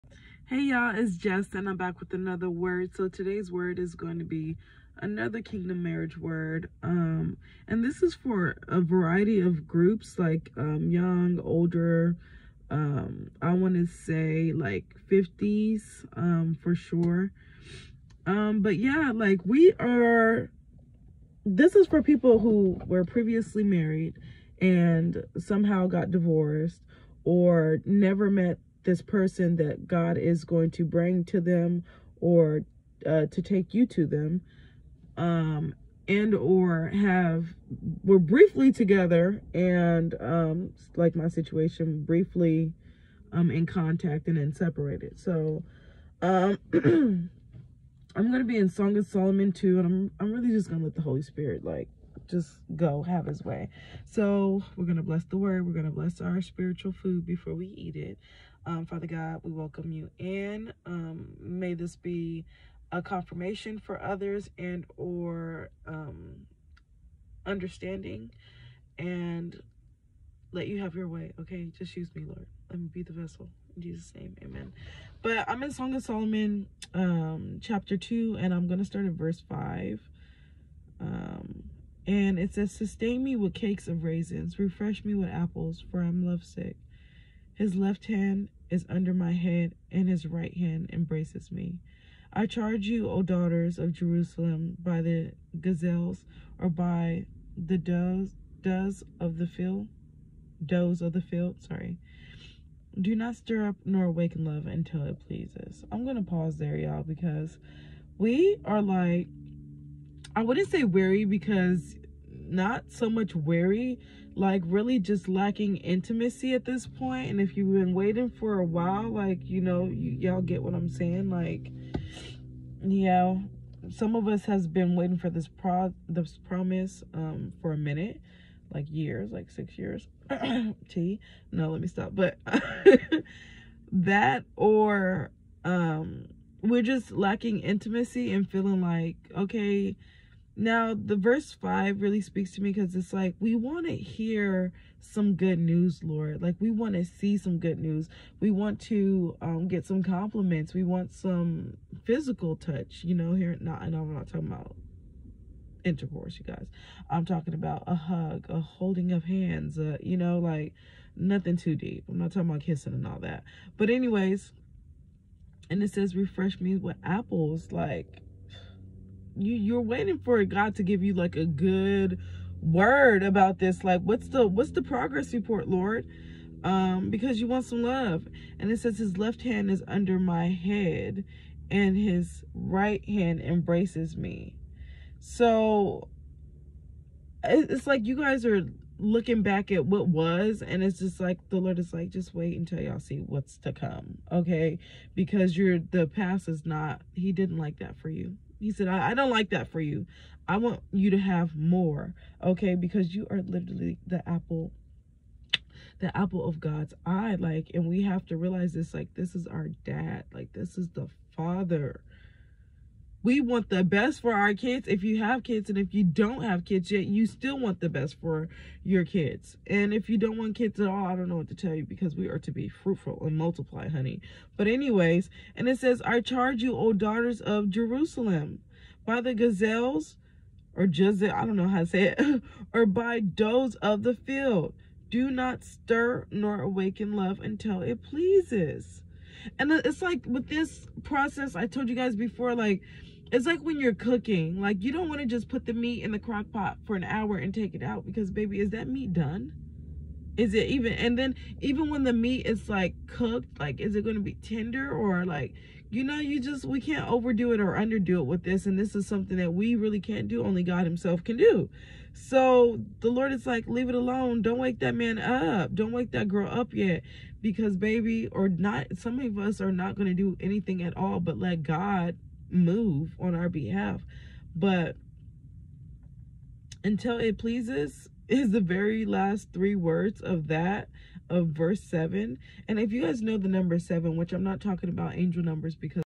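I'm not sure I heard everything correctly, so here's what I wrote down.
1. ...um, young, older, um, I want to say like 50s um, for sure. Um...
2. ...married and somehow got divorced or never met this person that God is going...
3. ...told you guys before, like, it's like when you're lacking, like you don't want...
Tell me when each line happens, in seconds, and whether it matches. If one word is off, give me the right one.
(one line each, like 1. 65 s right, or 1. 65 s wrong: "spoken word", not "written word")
1. 10 s right
2. 23 s right
3. 241 s wrong: "cooking", not "lacking".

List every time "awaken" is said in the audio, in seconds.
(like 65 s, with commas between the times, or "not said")
104 s, 236 s.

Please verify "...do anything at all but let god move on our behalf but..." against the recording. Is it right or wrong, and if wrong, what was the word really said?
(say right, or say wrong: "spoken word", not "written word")
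right.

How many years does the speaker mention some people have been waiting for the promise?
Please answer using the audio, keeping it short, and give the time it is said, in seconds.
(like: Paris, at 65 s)
6, at 129 s.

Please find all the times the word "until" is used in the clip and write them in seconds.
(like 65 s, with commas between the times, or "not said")
104 s, 192 s, 237 s, 276 s.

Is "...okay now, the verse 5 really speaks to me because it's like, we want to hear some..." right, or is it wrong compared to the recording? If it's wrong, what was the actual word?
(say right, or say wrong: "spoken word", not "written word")
right.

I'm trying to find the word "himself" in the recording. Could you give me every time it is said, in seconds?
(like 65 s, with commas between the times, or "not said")
260 s.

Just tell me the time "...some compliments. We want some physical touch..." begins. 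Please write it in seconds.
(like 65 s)
149 s.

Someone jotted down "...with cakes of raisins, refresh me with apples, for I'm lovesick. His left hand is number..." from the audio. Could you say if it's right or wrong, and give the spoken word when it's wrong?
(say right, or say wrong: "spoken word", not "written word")
wrong: "under", not "number".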